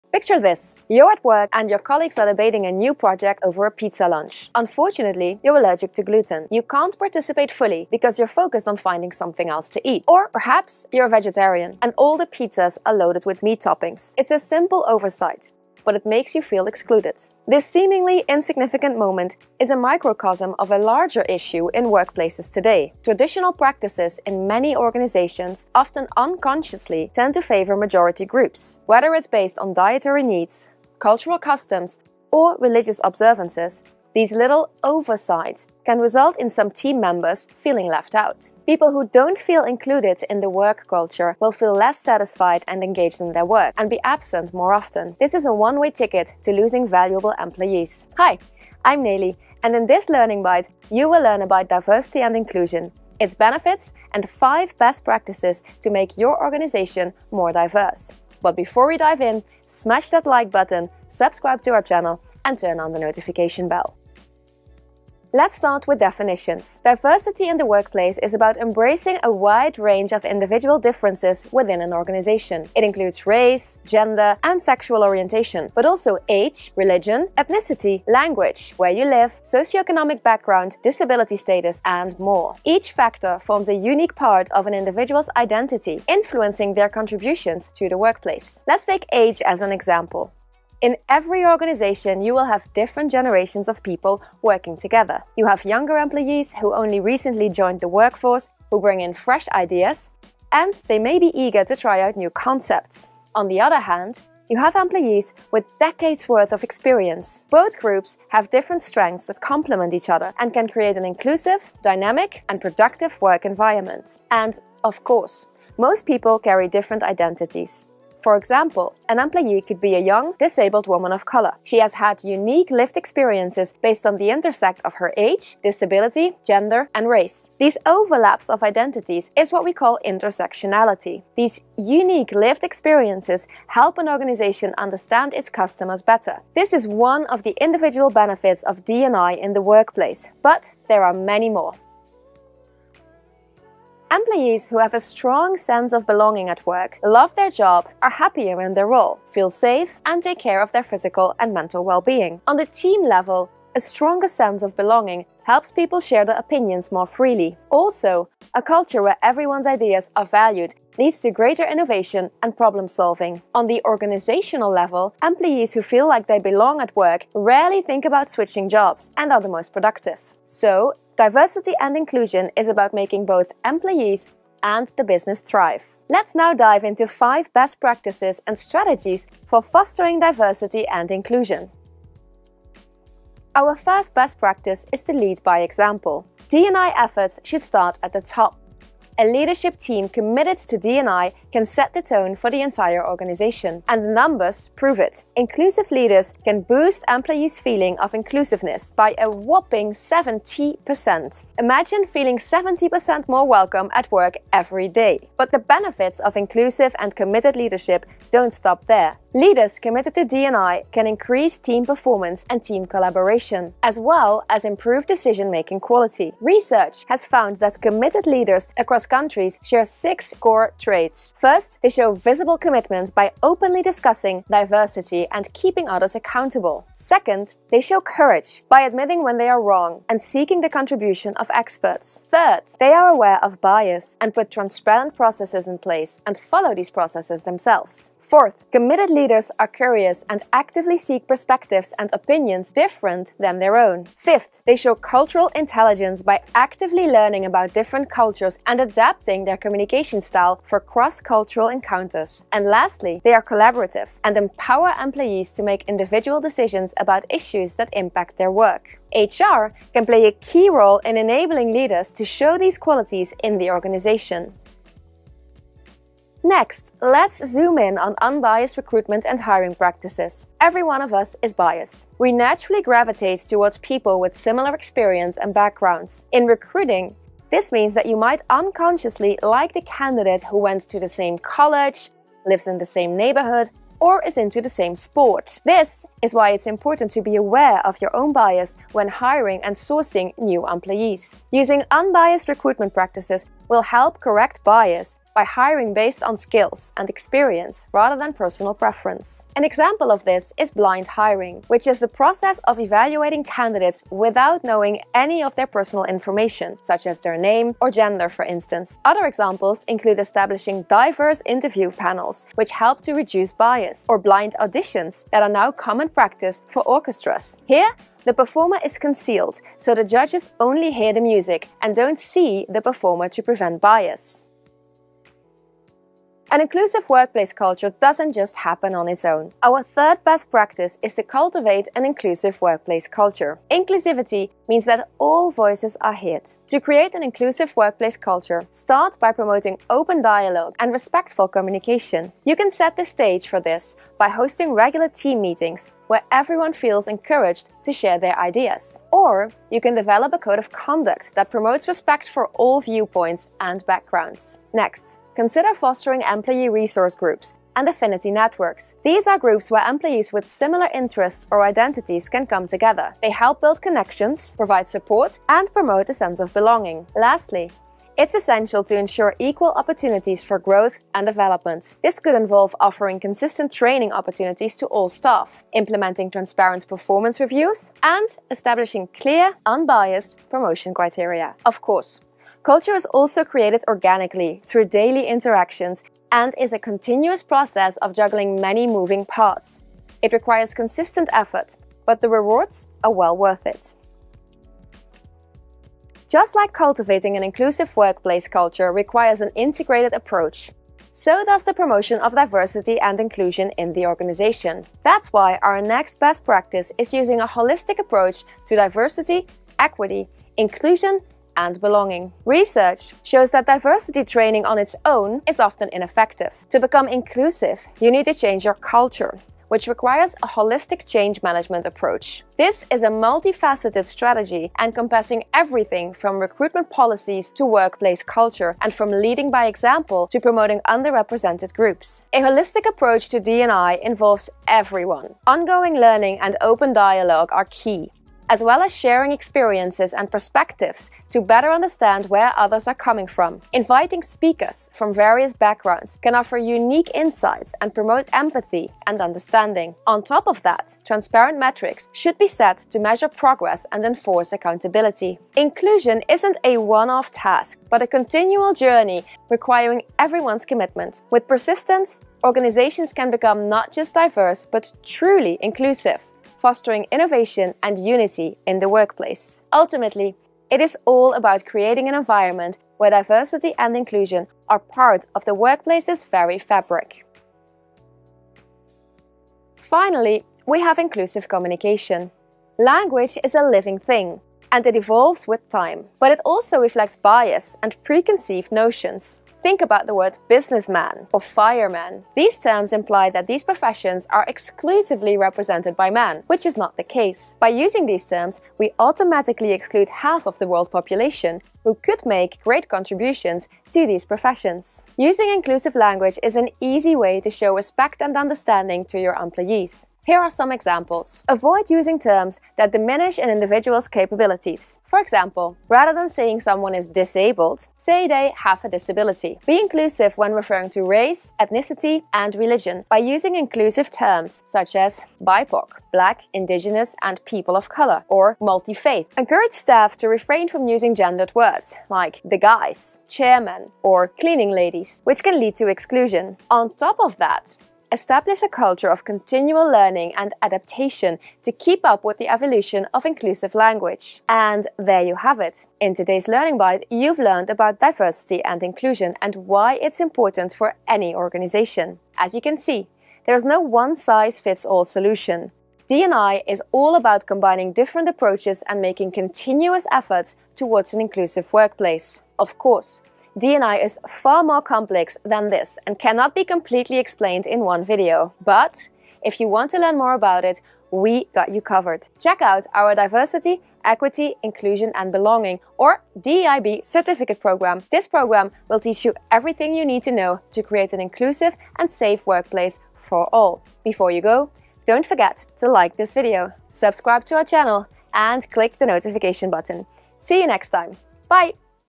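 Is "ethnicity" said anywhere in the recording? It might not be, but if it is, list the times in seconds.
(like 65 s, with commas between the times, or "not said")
77 s, 521 s.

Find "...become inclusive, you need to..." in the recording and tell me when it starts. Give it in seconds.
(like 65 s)
416 s.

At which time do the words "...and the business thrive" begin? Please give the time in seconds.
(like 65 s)
174 s.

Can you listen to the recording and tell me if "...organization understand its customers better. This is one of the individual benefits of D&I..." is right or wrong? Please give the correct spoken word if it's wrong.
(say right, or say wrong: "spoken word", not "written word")
right.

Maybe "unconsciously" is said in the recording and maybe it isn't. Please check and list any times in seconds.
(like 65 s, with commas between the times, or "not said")
26 s, 278 s.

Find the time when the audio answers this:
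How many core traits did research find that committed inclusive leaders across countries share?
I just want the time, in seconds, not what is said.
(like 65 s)
219 s.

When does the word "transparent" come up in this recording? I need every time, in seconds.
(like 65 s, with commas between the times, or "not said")
234 s, 376 s, 451 s.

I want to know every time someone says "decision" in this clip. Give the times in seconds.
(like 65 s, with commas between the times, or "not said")
215 s, 256 s.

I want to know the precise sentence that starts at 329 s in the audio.
Our third best practice is to cultivate an inclusive workplace culture.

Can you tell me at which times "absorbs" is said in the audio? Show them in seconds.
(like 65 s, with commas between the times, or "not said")
not said.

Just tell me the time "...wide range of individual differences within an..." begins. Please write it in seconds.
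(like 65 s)
69 s.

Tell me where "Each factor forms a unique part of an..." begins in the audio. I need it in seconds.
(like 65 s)
82 s.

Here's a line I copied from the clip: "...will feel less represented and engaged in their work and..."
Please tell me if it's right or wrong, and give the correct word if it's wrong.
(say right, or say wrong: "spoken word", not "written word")
wrong: "satisfied", not "represented".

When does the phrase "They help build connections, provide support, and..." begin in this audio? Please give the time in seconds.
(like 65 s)
363 s.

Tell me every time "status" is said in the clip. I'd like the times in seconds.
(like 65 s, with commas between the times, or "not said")
81 s.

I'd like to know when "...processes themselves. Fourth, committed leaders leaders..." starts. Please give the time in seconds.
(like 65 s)
236 s.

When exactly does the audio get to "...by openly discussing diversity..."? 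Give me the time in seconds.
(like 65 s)
223 s.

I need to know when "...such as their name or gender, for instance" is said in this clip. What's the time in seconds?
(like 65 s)
306 s.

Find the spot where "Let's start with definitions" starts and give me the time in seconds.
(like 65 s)
65 s.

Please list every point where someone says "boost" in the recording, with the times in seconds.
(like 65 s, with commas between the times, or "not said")
196 s.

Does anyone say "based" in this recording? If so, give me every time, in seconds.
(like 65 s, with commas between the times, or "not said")
29 s, 123 s, 295 s.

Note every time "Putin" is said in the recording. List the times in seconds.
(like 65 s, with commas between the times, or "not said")
not said.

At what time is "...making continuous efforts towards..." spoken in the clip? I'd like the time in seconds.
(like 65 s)
559 s.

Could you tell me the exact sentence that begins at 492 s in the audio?
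These terms imply that these professions are exclusively represented by men, which is not the case.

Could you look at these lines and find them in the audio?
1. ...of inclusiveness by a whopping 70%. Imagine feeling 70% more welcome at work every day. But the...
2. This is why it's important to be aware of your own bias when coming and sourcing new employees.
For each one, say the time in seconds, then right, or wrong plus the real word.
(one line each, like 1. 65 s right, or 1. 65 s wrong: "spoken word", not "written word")
1. 197 s right
2. 285 s wrong: "hiring", not "coming".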